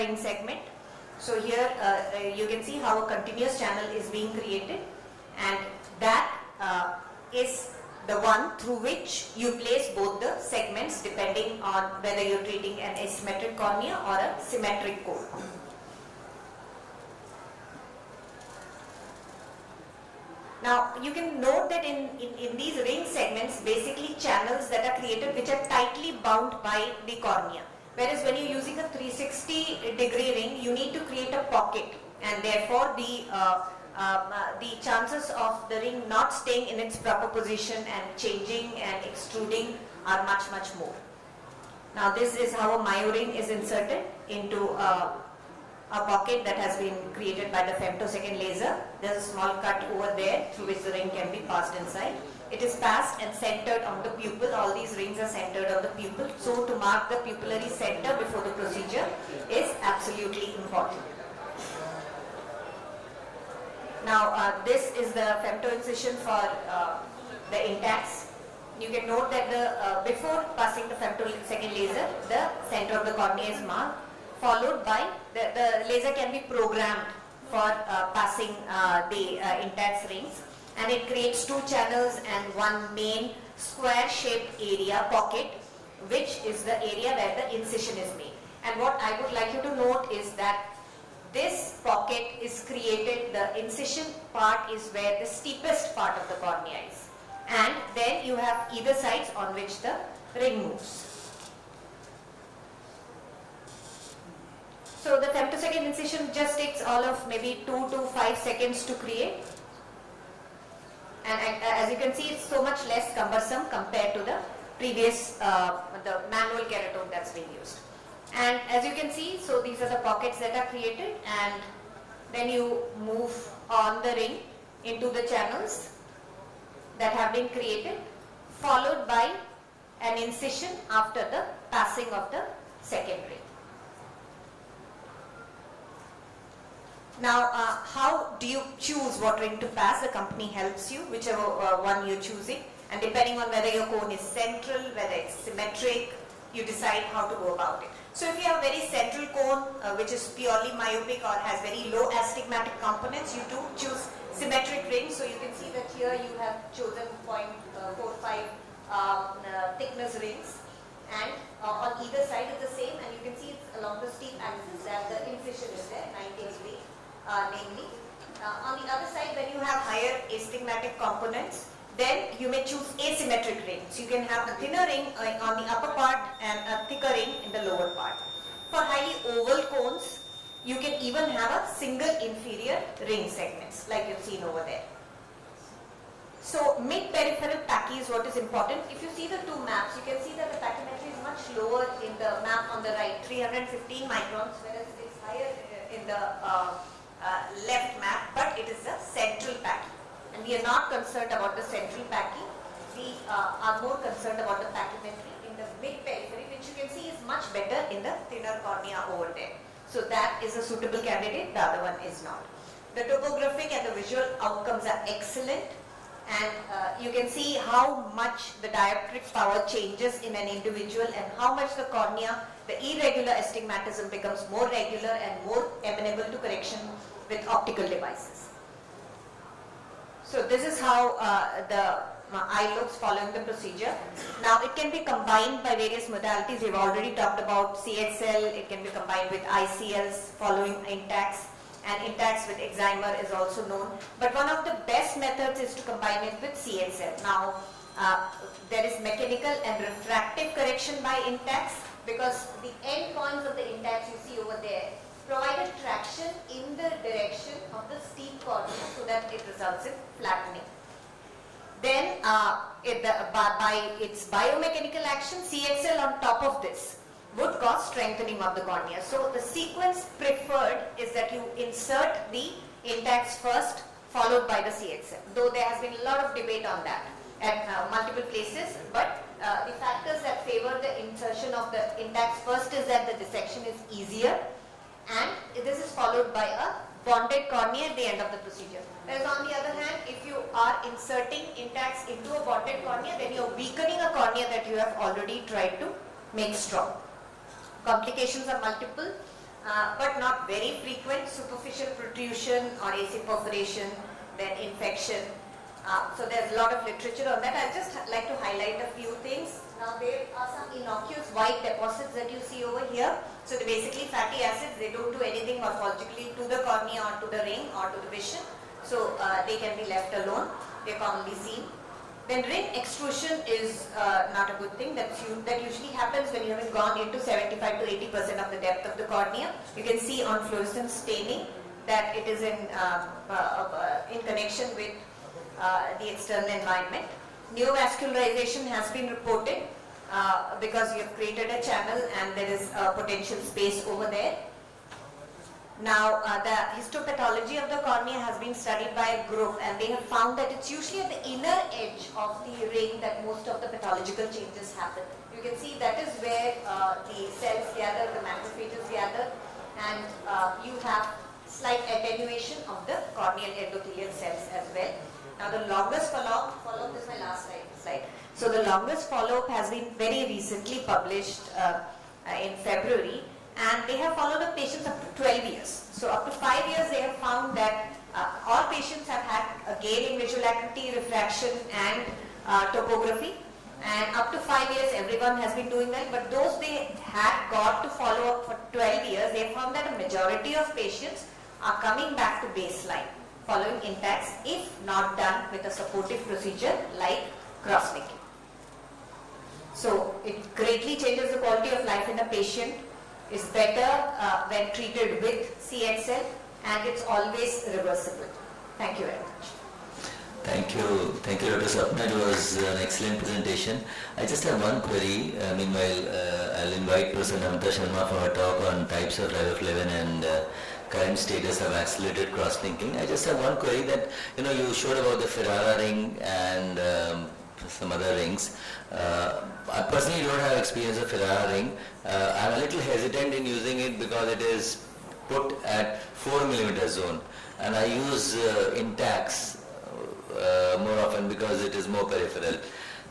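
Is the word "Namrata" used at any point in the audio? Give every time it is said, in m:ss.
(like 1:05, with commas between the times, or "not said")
6:57.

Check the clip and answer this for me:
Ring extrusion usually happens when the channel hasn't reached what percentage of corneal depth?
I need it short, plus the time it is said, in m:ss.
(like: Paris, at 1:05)
75 to 80%, at 5:27.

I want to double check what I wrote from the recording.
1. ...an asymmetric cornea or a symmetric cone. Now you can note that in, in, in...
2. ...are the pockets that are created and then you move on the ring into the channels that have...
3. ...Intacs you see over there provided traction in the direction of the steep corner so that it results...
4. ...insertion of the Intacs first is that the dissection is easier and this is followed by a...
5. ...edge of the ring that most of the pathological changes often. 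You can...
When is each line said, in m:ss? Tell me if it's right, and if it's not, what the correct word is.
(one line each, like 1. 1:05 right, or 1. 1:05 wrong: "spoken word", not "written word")
1. 0:12 right
2. 1:59 right
3. 4:13 right
4. 4:41 right
5. 5:51 wrong: "happen", not "often".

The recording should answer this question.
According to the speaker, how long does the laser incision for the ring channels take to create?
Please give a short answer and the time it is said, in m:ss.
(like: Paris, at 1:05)
2 to 5 seconds, at 1:47.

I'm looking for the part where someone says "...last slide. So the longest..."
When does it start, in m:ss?
6:07.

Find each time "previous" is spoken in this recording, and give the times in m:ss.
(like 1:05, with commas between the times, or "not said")
1:54.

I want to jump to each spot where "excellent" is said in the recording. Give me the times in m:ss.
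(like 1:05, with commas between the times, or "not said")
3:35, 6:52.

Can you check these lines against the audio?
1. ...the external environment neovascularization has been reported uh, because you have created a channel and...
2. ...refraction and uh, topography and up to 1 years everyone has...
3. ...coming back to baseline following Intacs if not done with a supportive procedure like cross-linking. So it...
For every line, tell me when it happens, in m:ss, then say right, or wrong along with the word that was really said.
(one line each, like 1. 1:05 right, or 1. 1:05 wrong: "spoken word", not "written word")
1. 5:35 right
2. 6:20 wrong: "5", not "1"
3. 6:31 right.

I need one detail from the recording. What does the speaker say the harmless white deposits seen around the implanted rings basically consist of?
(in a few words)
fatty acids.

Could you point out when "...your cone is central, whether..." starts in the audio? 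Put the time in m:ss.
2:23.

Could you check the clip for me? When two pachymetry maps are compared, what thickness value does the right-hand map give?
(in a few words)
315 microns.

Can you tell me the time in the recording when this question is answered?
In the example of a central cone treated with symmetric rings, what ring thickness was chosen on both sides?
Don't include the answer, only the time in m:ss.
2:37.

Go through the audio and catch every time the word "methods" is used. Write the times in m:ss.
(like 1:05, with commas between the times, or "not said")
4:05.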